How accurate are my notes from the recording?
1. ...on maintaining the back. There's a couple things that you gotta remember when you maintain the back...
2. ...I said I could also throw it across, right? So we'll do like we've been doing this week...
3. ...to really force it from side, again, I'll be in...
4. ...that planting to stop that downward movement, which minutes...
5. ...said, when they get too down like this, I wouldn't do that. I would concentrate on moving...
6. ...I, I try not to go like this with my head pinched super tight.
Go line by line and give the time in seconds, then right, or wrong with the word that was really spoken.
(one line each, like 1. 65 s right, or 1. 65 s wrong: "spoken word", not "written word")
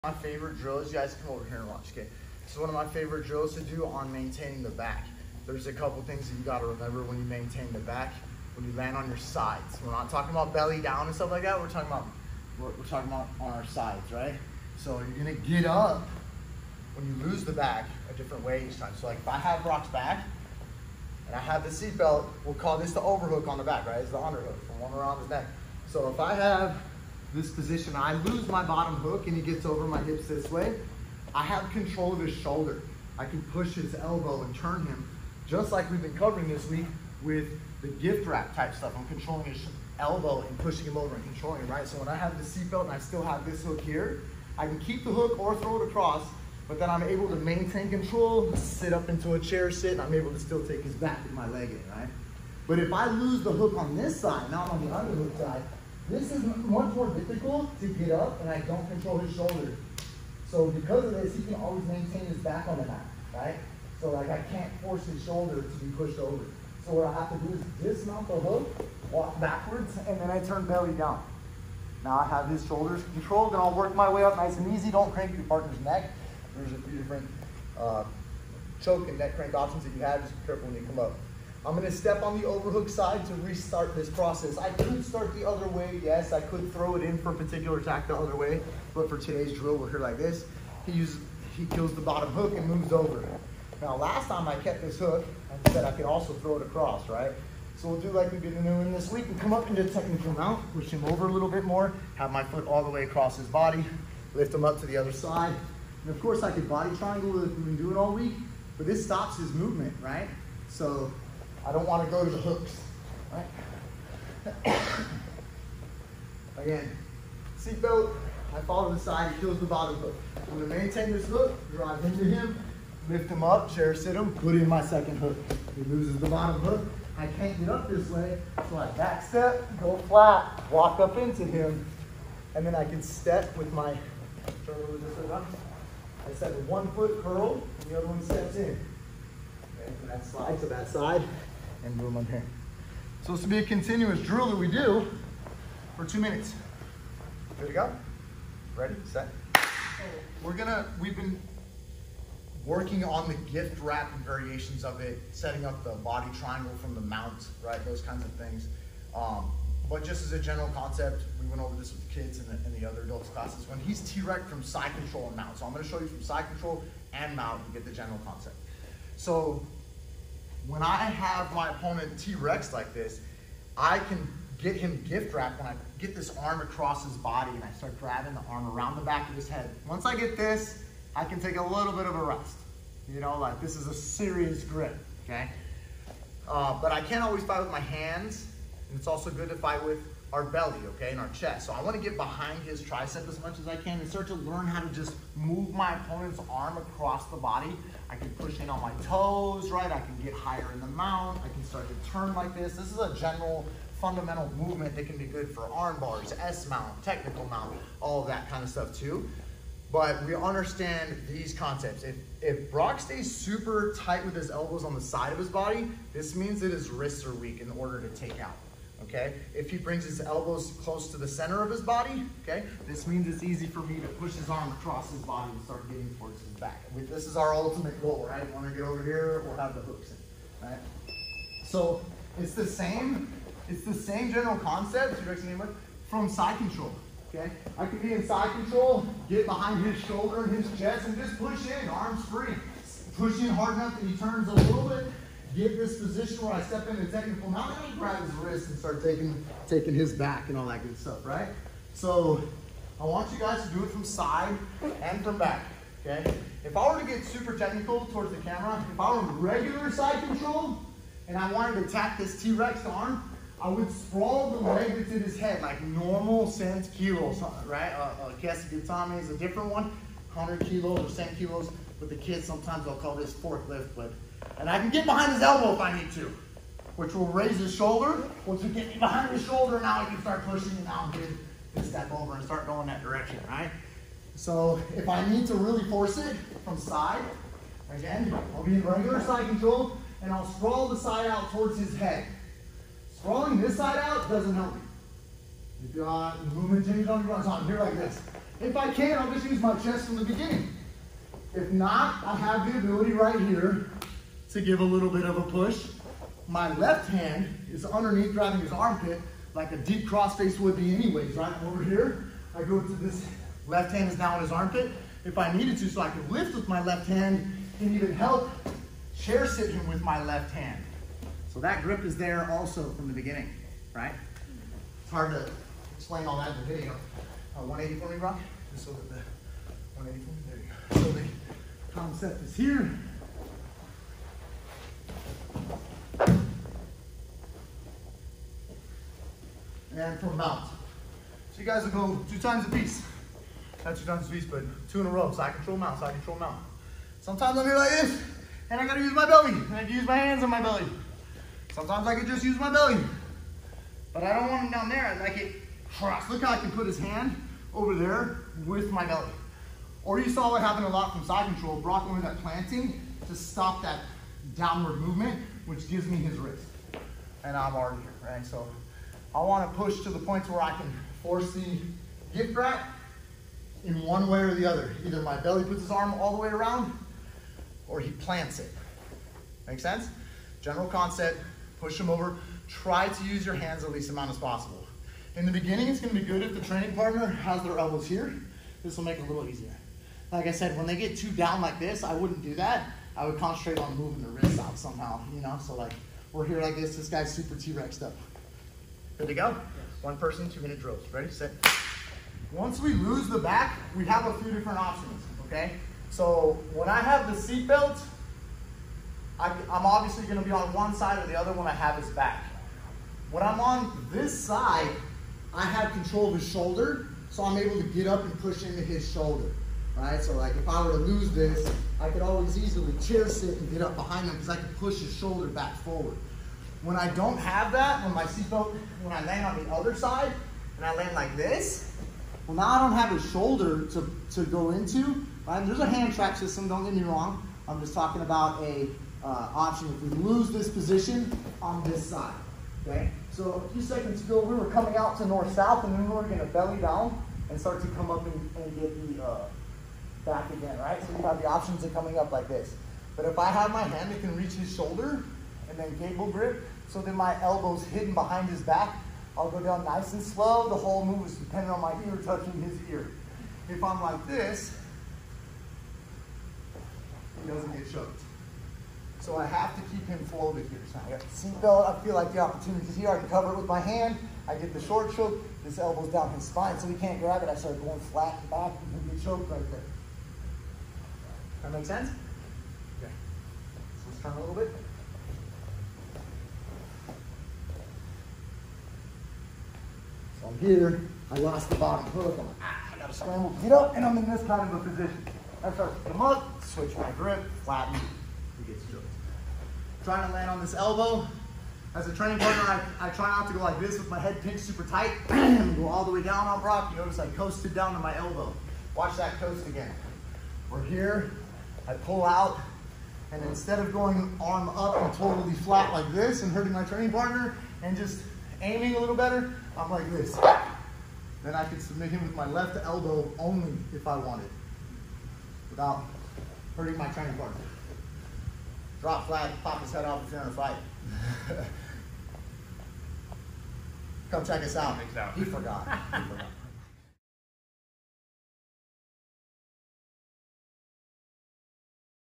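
1. 3 s right
2. 95 s right
3. 285 s right
4. 362 s wrong: "gives", not "minutes"
5. 390 s right
6. 503 s right.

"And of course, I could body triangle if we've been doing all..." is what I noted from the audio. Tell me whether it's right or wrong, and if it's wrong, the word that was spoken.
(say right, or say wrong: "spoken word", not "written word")
right.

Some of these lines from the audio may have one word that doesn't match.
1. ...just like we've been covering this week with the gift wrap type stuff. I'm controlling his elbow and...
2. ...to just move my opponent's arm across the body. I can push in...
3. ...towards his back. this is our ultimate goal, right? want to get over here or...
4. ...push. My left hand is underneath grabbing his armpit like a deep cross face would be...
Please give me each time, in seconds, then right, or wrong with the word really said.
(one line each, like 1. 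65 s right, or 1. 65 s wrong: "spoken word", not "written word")
1. 35 s right
2. 194 s right
3. 226 s right
4. 305 s right.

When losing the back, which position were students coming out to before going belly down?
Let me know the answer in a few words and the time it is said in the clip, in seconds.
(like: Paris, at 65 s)
north-south, at 445 s.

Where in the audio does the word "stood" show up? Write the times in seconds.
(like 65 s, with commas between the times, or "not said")
not said.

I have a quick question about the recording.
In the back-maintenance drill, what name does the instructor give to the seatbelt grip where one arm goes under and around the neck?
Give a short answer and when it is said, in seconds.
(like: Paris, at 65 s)
the overhook on the back, at 22 s.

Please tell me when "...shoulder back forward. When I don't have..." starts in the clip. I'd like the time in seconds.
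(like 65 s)
425 s.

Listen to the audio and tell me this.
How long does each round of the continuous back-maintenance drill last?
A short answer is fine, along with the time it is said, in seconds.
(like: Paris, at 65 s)
2 minutes, at 146 s.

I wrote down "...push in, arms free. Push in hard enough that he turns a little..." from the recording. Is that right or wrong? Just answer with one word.
right.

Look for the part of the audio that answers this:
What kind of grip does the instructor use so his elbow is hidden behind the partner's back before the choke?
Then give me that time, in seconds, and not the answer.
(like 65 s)
455 s.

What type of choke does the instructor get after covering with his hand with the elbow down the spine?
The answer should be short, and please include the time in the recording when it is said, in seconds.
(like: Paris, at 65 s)
short choke, at 474 s.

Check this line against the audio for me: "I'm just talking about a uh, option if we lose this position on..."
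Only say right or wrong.
right.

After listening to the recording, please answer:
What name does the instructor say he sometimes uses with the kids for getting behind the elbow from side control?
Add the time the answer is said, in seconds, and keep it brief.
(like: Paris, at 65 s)
forklift, at 273 s.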